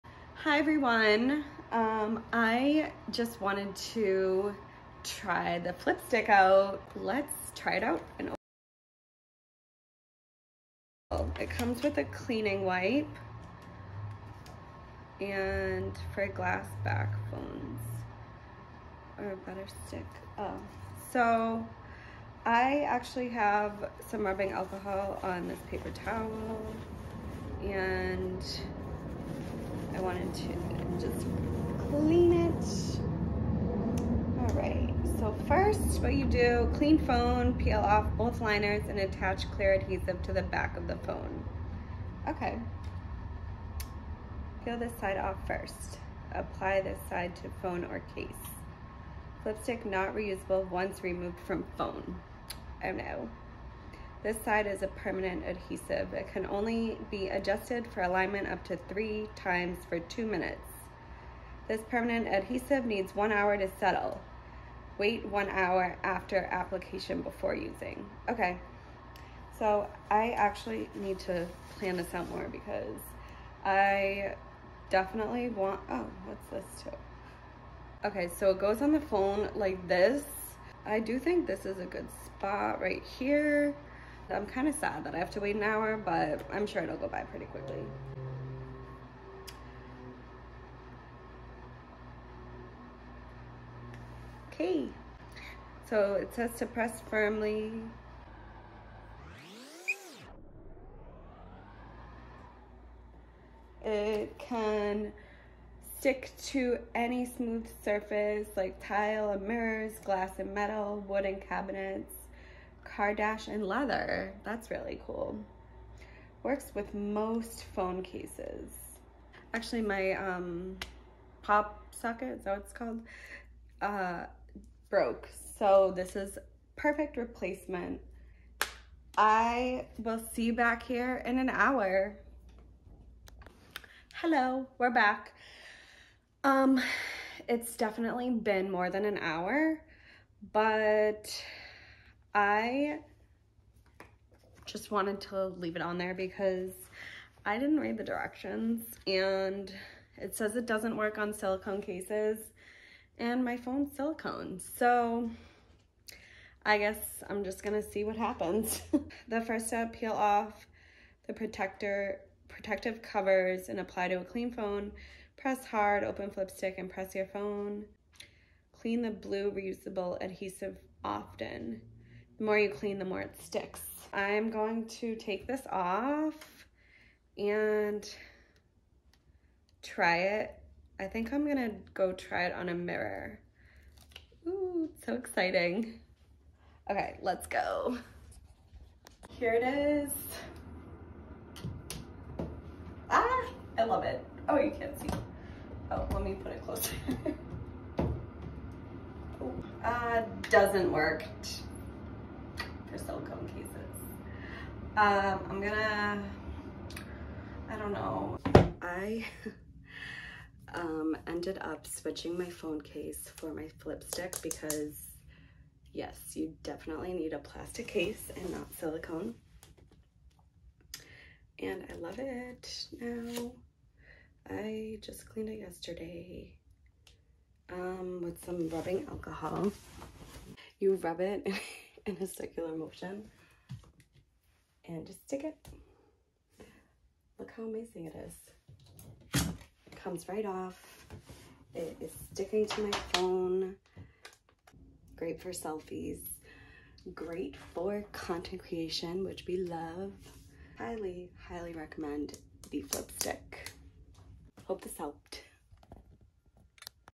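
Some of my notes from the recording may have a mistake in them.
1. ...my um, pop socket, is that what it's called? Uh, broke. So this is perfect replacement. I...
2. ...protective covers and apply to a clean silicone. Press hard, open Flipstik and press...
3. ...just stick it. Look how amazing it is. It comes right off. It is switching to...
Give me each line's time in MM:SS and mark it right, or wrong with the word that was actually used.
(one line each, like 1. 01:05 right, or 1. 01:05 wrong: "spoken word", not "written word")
1. 01:59 right
2. 02:42 wrong: "phone", not "silicone"
3. 03:55 wrong: "sticking", not "switching".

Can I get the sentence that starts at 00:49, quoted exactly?
Flipstik not reusable once removed from phone.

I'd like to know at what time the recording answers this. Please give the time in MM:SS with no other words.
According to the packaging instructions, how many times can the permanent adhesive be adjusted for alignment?
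00:58.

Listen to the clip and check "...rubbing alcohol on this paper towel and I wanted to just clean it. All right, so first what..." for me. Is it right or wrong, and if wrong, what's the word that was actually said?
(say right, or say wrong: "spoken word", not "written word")
right.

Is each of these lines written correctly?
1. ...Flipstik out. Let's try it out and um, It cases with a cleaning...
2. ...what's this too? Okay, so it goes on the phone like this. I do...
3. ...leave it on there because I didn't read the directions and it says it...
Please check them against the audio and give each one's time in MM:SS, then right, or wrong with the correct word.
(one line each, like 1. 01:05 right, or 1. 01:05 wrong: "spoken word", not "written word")
1. 00:05 wrong: "comes", not "cases"
2. 01:16 right
3. 02:25 right.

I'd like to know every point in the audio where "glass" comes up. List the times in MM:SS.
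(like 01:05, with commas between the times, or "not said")
00:16, 01:50.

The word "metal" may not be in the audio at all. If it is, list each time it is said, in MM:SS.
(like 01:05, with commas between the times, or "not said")
01:50.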